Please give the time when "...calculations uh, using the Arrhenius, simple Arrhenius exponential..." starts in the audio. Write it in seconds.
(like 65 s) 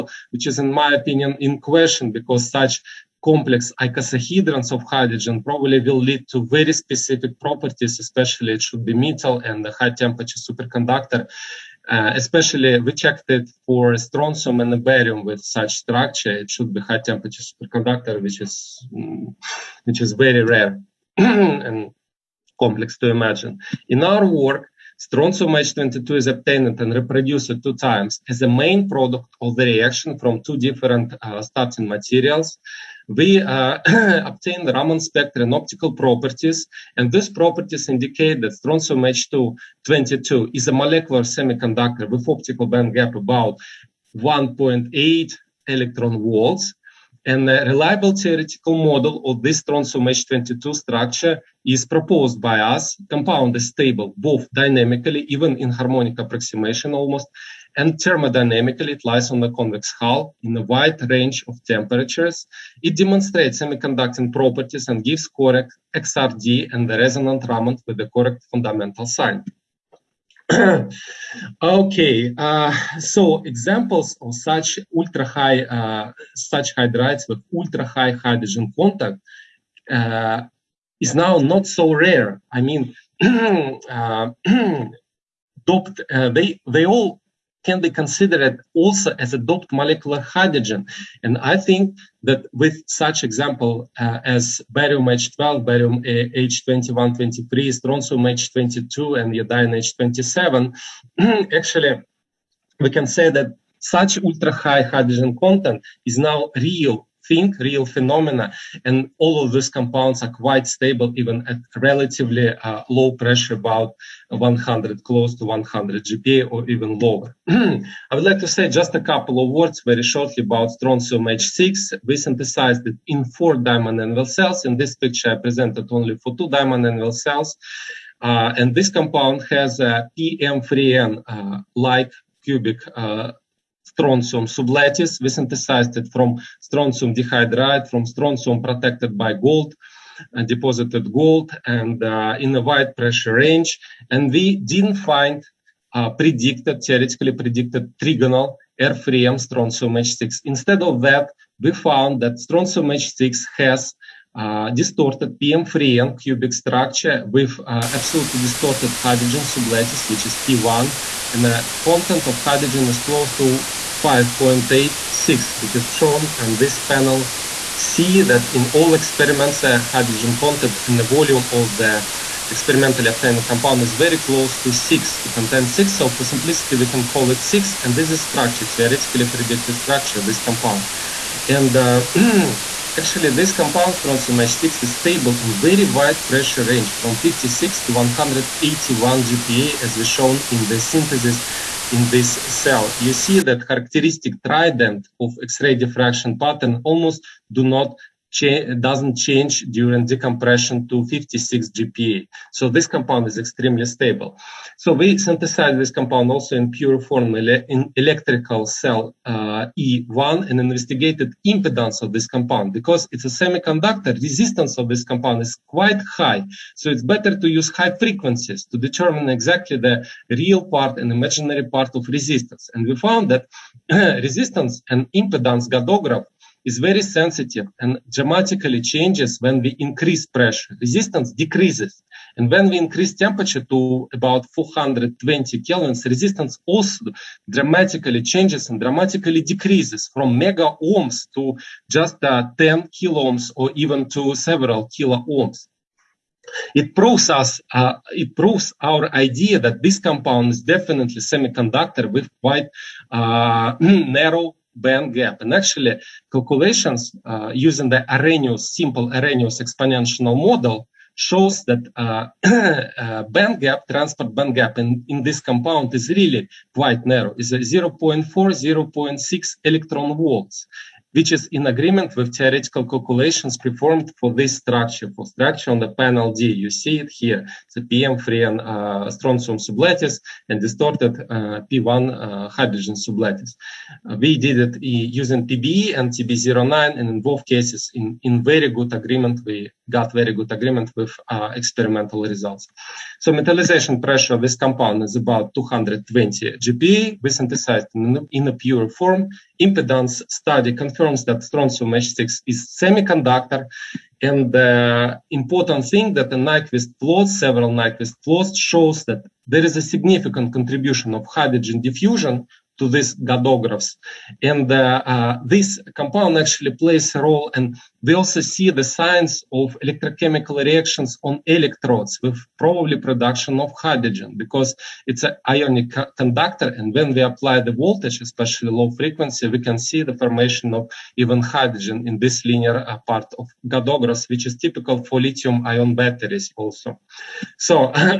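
256 s.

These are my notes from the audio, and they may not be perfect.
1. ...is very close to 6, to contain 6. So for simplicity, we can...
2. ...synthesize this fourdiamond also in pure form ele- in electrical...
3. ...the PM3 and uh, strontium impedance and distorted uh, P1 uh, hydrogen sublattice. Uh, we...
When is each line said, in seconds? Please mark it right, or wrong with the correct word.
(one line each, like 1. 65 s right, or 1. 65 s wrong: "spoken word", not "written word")
1. 173 s right
2. 205 s wrong: "compound", not "fourdiamond"
3. 277 s wrong: "sublattice", not "impedance".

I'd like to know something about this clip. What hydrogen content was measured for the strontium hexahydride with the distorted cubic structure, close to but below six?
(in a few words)
5.86.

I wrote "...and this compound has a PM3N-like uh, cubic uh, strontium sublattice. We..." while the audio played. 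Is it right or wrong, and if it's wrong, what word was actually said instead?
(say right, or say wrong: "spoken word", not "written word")
right.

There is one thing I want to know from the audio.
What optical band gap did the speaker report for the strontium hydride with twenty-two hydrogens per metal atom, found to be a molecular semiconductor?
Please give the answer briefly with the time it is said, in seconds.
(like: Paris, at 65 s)
1.8 electron volts, at 44 s.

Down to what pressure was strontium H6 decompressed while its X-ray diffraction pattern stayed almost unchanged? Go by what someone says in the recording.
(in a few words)
56 GPa.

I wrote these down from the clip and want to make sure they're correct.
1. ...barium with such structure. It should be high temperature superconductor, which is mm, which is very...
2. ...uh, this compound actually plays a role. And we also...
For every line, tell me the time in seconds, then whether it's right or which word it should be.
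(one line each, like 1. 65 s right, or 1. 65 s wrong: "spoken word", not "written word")
1. 14 s right
2. 315 s right.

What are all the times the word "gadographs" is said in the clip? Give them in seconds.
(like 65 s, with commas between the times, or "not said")
225 s, 313 s, 333 s.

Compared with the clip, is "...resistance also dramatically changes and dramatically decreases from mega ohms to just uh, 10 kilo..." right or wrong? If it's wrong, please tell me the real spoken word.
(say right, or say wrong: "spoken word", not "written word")
right.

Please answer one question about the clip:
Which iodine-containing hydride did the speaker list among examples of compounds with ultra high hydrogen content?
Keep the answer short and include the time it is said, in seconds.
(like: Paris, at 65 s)
iodine H27, at 99 s.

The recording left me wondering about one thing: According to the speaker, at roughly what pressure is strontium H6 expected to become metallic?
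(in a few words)
220 GPa.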